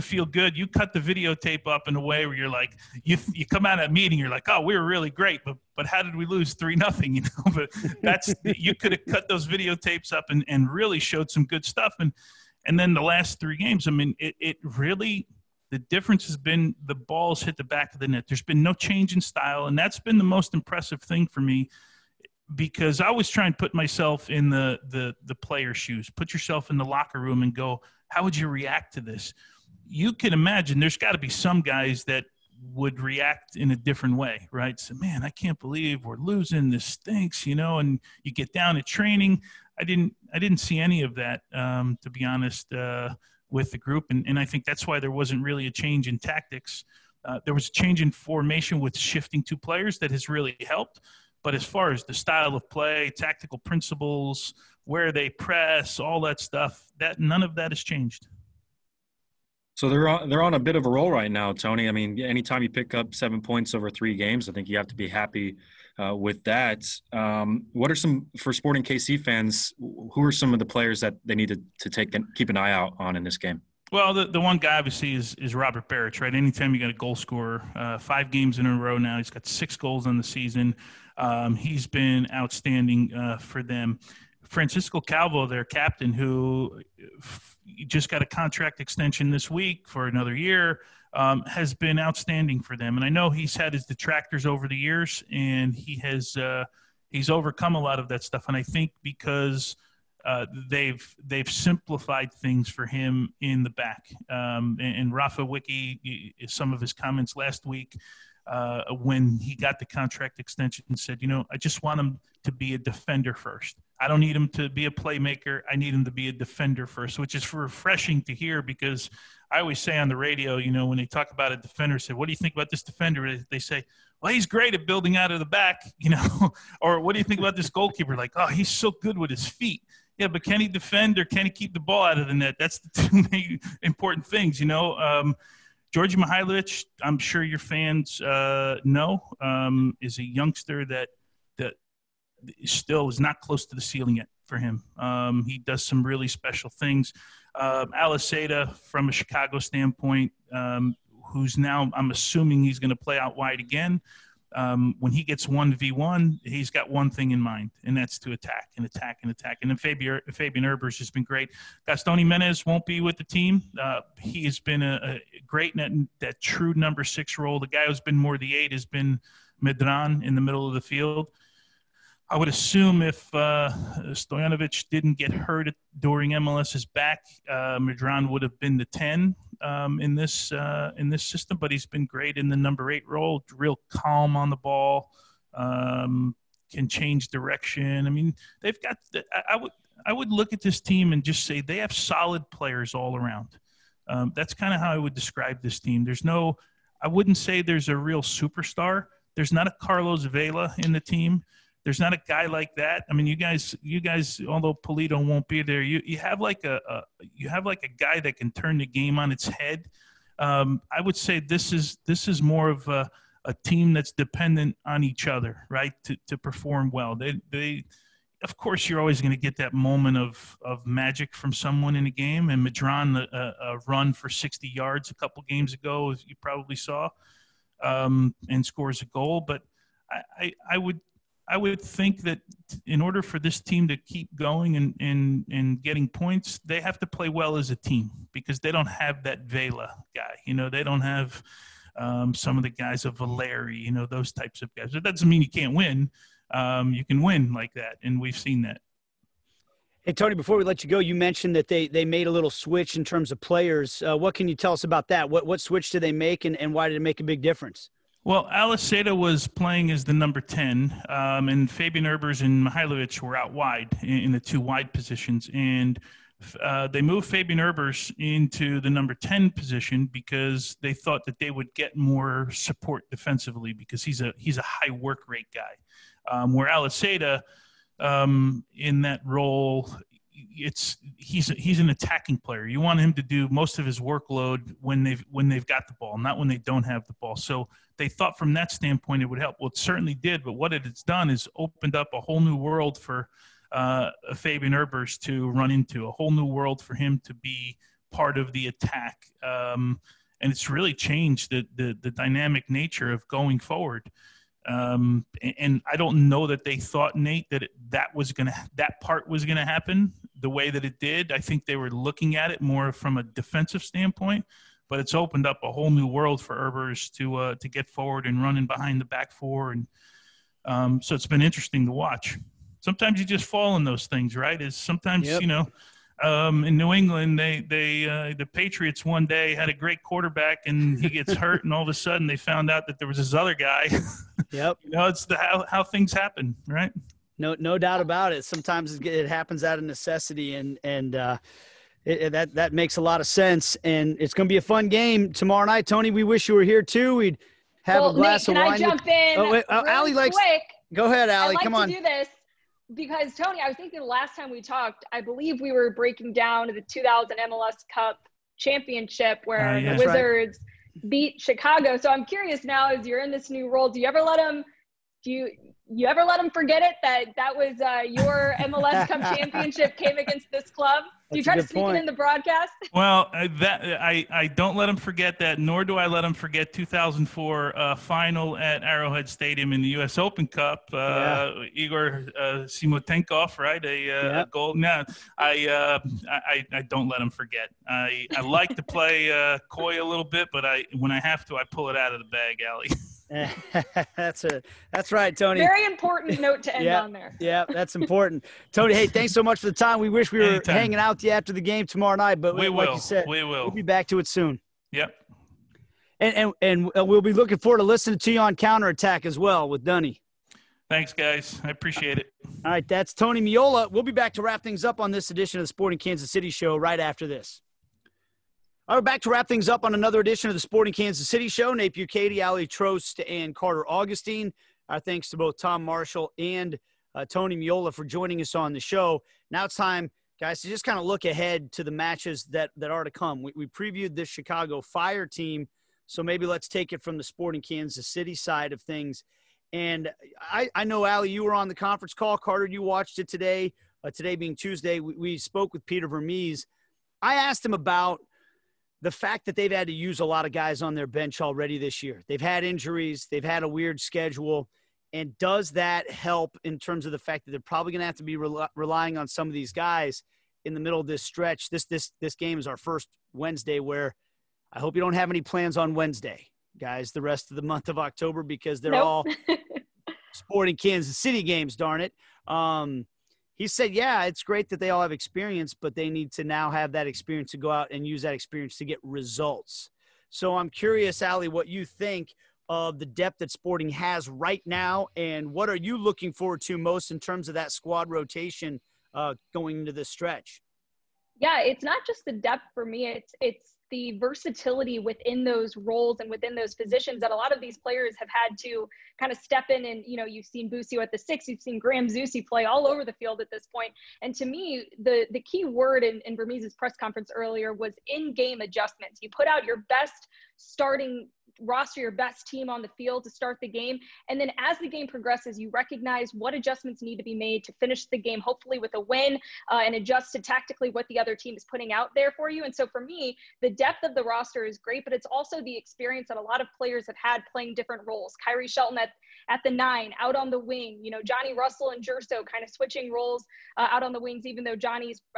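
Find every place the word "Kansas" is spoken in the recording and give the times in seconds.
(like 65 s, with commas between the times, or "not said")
415 s, 420 s, 437 s, 470 s.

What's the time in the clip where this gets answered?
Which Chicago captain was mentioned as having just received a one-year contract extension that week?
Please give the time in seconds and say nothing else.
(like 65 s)
84 s.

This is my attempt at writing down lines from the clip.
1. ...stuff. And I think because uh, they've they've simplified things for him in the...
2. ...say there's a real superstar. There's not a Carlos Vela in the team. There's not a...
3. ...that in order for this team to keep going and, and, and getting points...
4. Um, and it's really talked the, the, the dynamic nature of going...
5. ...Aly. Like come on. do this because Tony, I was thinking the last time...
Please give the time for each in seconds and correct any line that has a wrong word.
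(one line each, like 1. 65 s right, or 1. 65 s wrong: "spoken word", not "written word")
1. 98 s right
2. 197 s right
3. 232 s right
4. 299 s wrong: "changed", not "talked"
5. 351 s right.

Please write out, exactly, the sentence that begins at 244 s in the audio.
That doesn't mean you can't win.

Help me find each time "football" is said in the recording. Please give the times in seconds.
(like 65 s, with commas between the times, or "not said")
not said.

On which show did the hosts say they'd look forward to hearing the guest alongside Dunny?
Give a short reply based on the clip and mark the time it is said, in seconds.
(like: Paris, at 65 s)
Counterattack, at 408 s.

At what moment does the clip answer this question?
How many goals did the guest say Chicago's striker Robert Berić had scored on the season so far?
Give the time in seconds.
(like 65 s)
79 s.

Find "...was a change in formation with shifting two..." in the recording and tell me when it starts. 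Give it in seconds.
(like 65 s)
47 s.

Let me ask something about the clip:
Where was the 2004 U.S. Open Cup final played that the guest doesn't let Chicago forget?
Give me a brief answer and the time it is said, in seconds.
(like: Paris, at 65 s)
Arrowhead Stadium, at 378 s.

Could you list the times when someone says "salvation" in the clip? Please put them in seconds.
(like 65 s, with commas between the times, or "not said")
not said.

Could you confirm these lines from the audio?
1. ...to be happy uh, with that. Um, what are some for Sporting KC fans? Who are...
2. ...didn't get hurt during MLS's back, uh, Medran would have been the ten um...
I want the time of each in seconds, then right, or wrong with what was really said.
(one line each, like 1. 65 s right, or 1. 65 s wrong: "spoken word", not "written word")
1. 64 s right
2. 174 s right.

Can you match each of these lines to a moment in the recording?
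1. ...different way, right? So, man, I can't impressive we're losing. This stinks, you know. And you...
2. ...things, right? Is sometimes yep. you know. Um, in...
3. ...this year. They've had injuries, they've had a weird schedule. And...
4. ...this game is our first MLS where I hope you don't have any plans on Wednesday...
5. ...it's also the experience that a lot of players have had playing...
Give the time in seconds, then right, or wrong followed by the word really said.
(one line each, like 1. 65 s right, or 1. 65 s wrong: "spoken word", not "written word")
1. 33 s wrong: "believe", not "impressive"
2. 324 s right
3. 451 s right
4. 462 s wrong: "Wednesday", not "MLS"
5. 525 s right.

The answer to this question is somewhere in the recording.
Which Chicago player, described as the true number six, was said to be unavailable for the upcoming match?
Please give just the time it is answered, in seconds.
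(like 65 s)
161 s.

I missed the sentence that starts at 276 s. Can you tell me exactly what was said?
Um, where Aliseda, um, in that role, it's he's he's an attacking player.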